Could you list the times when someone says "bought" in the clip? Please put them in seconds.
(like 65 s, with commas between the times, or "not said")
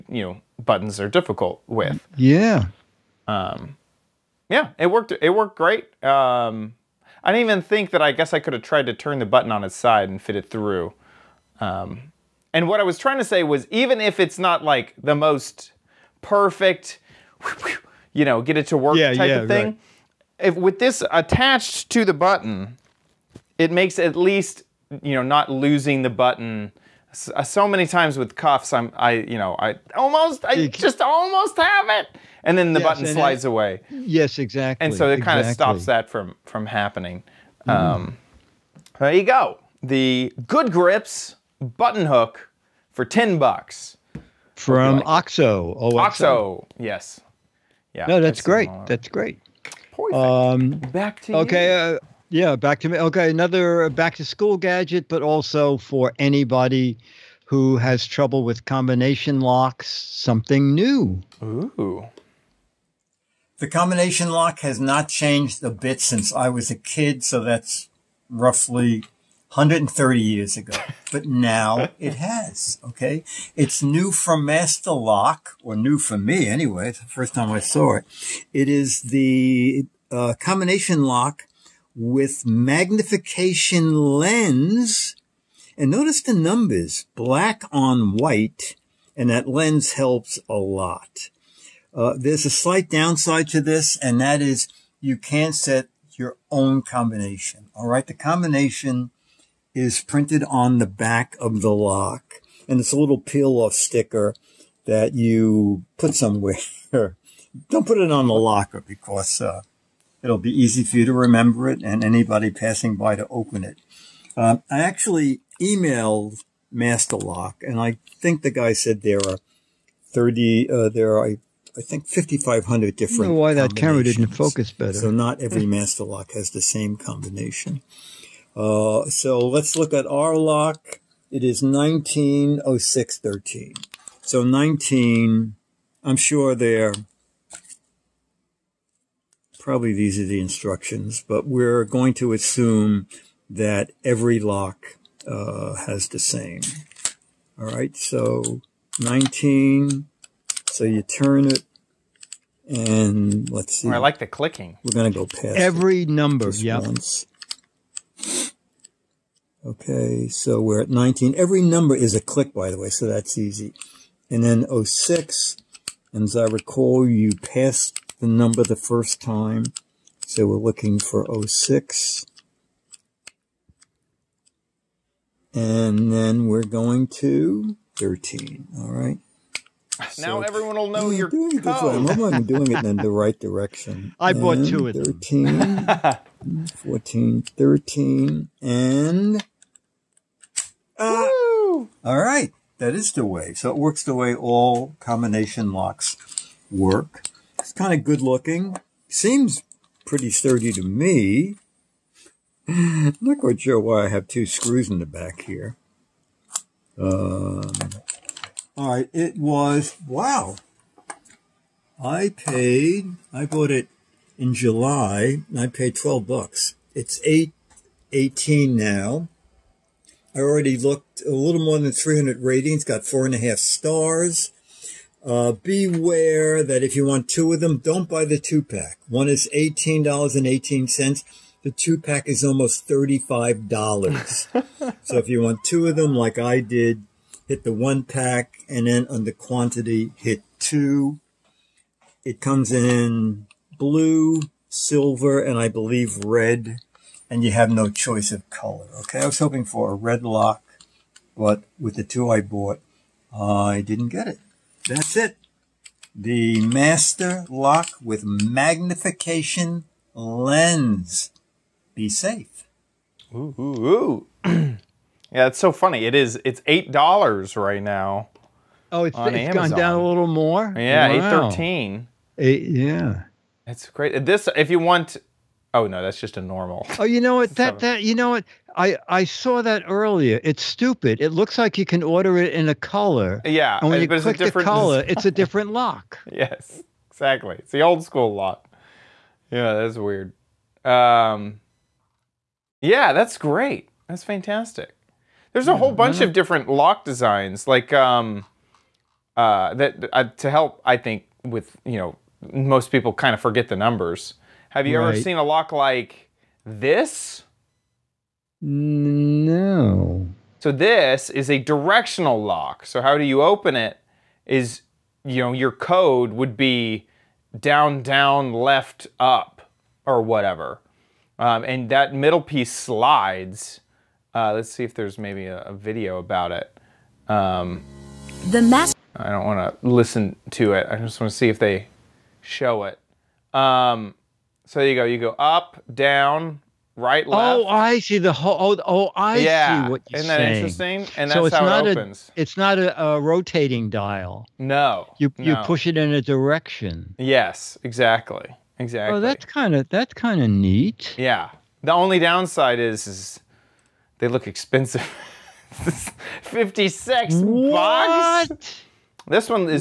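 184 s, 213 s, 252 s.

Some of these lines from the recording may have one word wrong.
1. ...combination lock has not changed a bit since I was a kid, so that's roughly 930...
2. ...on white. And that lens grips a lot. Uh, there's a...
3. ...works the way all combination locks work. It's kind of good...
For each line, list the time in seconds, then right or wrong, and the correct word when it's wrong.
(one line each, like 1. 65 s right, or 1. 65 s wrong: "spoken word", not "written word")
1. 63 s wrong: "130", not "930"
2. 87 s wrong: "helps", not "grips"
3. 193 s right.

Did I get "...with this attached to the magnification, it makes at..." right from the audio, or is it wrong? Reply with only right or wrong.
wrong.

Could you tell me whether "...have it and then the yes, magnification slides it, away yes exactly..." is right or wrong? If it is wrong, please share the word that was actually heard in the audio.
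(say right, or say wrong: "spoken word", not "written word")
wrong: "button", not "magnification".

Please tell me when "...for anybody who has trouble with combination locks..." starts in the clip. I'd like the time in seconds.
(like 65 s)
55 s.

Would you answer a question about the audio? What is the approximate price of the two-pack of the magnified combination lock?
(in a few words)
almost $35.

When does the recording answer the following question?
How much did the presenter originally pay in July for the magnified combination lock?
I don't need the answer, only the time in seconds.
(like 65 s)
215 s.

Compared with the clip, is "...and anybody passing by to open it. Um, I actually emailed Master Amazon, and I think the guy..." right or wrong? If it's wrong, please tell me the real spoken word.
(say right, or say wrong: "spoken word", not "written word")
wrong: "Lock", not "Amazon".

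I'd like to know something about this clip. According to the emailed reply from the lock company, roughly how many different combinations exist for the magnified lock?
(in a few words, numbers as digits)
5,500.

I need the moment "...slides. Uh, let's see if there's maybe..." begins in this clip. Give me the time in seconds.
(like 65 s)
322 s.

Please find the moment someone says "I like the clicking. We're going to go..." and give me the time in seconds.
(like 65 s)
153 s.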